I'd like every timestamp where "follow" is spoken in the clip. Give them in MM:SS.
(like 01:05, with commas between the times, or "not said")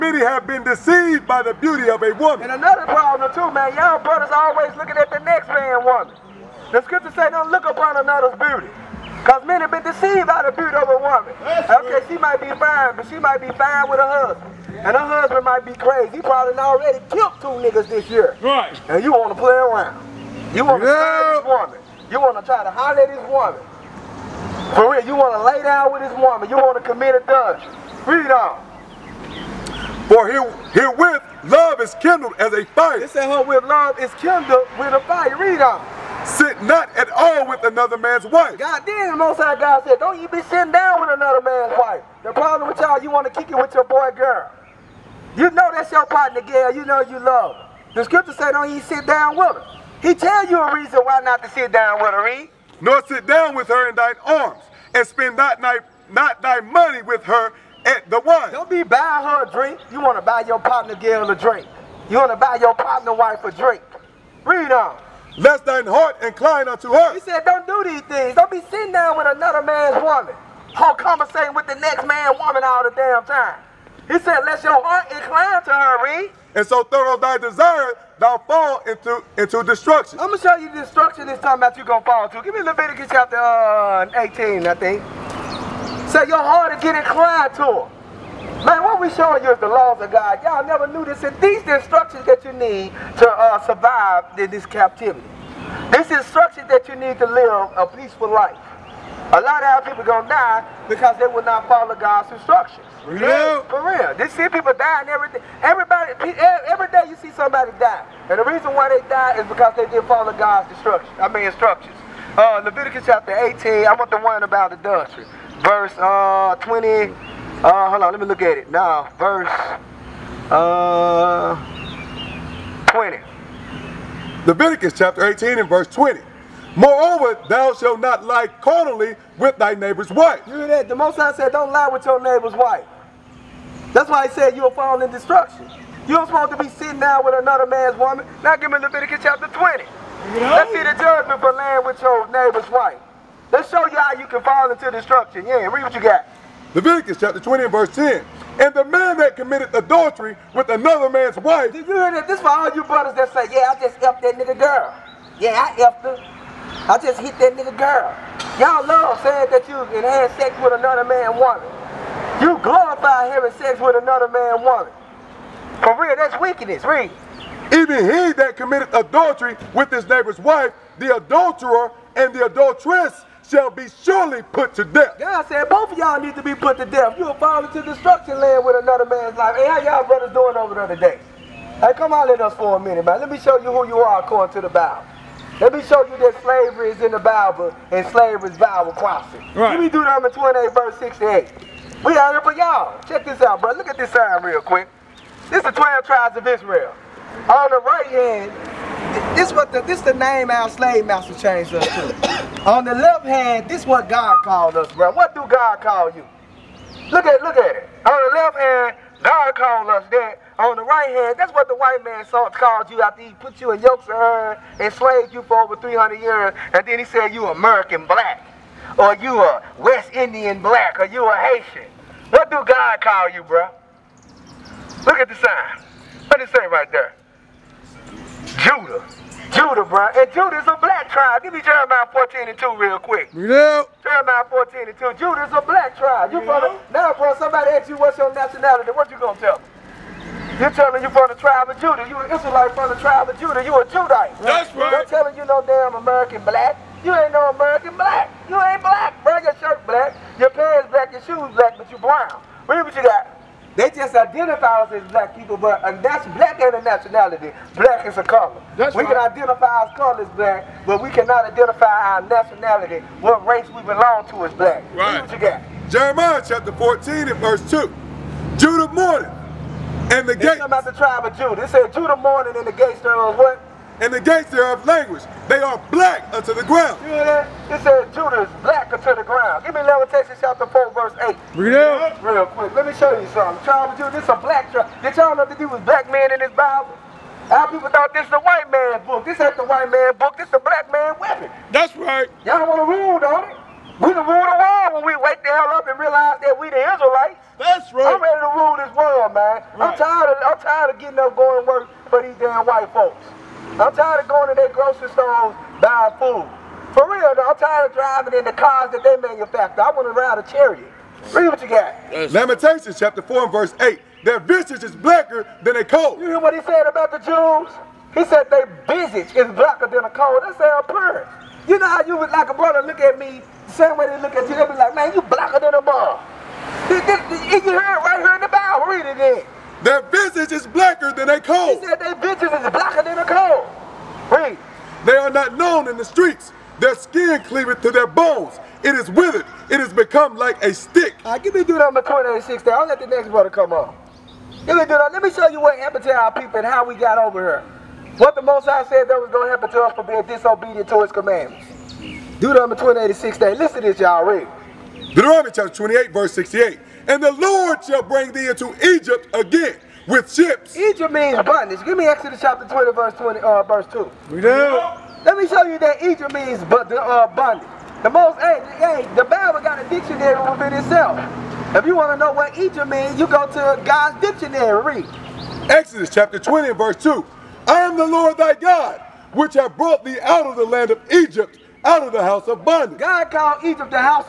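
01:41, 01:50.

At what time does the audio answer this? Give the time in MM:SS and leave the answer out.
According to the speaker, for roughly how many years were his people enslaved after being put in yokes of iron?
03:35.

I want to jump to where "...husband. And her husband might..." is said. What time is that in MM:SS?
00:14.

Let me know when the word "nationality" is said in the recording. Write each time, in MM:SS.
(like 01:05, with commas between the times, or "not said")
03:58, 04:16, 04:22.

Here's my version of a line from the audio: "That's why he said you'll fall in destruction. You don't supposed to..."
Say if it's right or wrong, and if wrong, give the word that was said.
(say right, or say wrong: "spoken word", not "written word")
right.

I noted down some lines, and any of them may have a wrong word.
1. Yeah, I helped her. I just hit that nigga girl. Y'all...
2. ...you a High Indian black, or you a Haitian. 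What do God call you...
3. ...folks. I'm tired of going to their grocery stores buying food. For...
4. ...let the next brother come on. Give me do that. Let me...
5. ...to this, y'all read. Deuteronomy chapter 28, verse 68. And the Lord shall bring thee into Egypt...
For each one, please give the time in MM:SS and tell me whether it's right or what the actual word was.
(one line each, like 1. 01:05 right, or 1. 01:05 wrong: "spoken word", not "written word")
1. 02:35 right
2. 03:39 wrong: "West", not "High"
3. 05:02 right
4. 05:42 right
5. 05:53 right.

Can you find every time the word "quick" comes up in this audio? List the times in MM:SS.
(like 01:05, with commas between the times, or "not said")
03:14, 03:52, 04:42.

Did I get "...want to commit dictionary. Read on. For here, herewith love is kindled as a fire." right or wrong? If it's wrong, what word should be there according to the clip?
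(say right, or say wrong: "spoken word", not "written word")
wrong: "adultery", not "dictionary".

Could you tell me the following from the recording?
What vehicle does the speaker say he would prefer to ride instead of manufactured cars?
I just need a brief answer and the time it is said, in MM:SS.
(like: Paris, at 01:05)
A chariot, at 05:10.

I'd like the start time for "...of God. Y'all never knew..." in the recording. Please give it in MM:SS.
01:30.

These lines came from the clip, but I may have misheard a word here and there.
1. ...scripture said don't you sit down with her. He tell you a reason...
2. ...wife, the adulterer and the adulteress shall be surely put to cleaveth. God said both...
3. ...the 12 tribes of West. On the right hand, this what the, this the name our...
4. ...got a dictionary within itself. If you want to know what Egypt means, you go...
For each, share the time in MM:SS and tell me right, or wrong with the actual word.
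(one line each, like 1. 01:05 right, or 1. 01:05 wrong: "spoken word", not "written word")
1. 00:48 right
2. 02:50 wrong: "death", not "cleaveth"
3. 03:15 wrong: "Israel", not "West"
4. 06:09 right.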